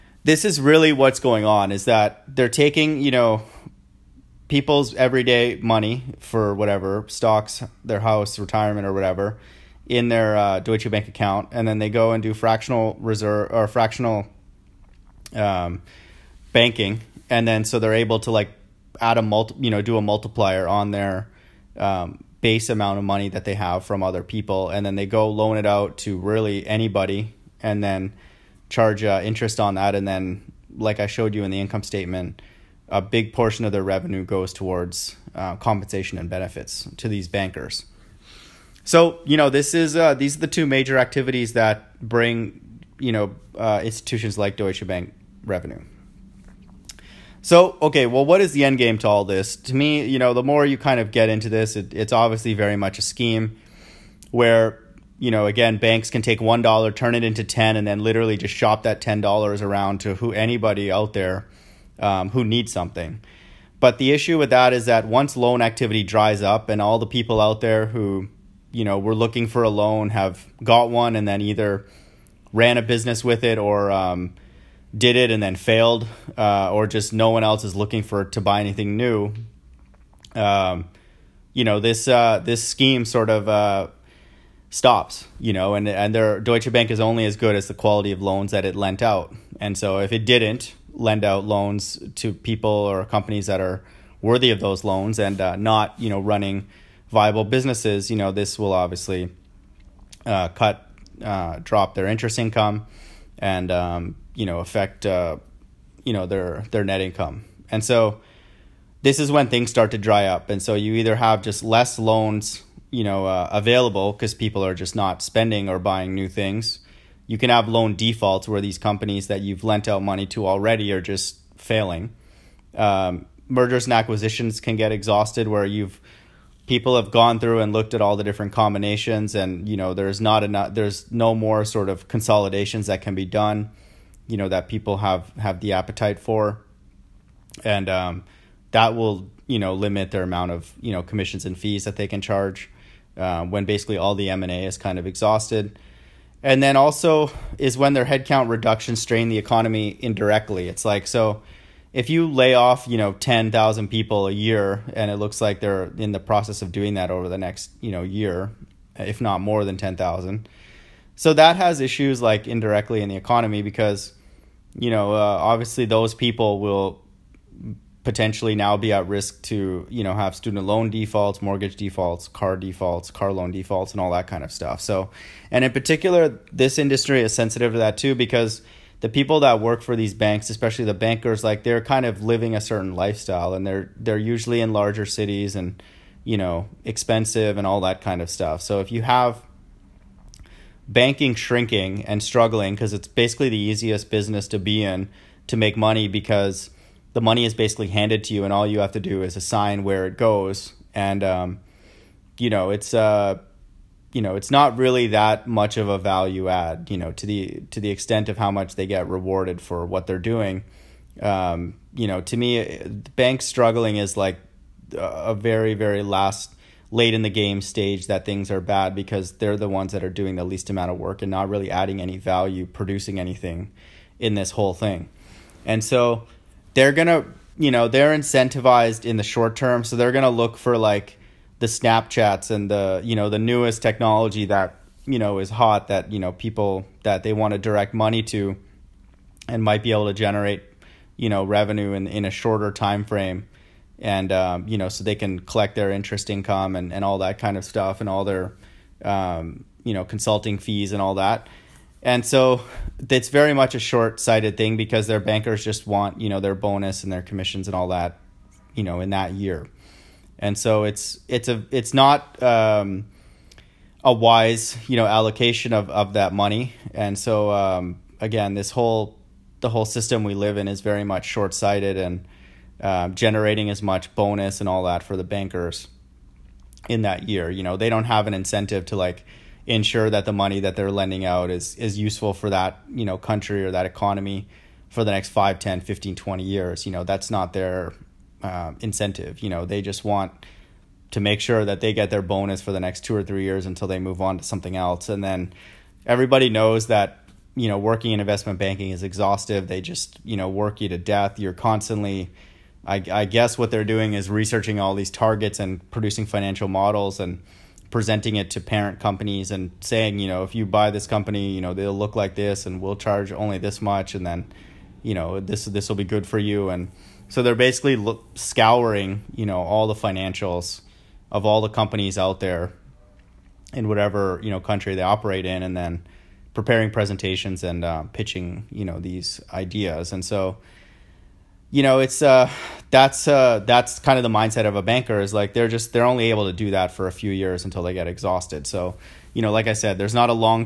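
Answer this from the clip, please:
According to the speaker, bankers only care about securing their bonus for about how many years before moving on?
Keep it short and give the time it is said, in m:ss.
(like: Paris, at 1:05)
2 or 3, at 4:53.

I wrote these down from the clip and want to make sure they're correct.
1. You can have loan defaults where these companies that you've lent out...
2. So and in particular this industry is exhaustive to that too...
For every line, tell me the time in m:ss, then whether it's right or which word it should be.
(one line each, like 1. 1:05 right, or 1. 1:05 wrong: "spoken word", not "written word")
1. 1:57 right
2. 2:54 wrong: "sensitive", not "exhaustive".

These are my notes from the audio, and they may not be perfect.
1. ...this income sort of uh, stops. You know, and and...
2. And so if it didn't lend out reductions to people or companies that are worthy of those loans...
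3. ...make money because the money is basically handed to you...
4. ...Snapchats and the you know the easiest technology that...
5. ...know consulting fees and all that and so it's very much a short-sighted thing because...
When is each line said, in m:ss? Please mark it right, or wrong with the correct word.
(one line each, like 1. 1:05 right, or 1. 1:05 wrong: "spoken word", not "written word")
1. 1:22 wrong: "scheme", not "income"
2. 1:29 wrong: "loans", not "reductions"
3. 3:15 right
4. 3:51 wrong: "newest", not "easiest"
5. 4:09 right.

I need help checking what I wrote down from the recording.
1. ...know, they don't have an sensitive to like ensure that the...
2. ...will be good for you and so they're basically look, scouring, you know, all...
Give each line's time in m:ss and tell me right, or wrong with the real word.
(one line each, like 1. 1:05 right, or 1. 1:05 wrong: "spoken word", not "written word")
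1. 4:37 wrong: "incentive", not "sensitive"
2. 5:15 right.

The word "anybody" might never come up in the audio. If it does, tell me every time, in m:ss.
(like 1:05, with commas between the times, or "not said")
0:26, 1:00.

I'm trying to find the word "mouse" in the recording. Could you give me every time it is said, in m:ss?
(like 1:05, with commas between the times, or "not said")
not said.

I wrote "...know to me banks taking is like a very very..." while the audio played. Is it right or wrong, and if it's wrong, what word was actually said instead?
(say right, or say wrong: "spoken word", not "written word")
wrong: "struggling", not "taking".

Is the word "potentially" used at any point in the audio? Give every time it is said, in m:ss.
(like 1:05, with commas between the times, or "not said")
2:48.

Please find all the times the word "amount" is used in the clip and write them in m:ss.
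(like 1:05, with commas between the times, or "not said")
0:22, 2:20, 3:40.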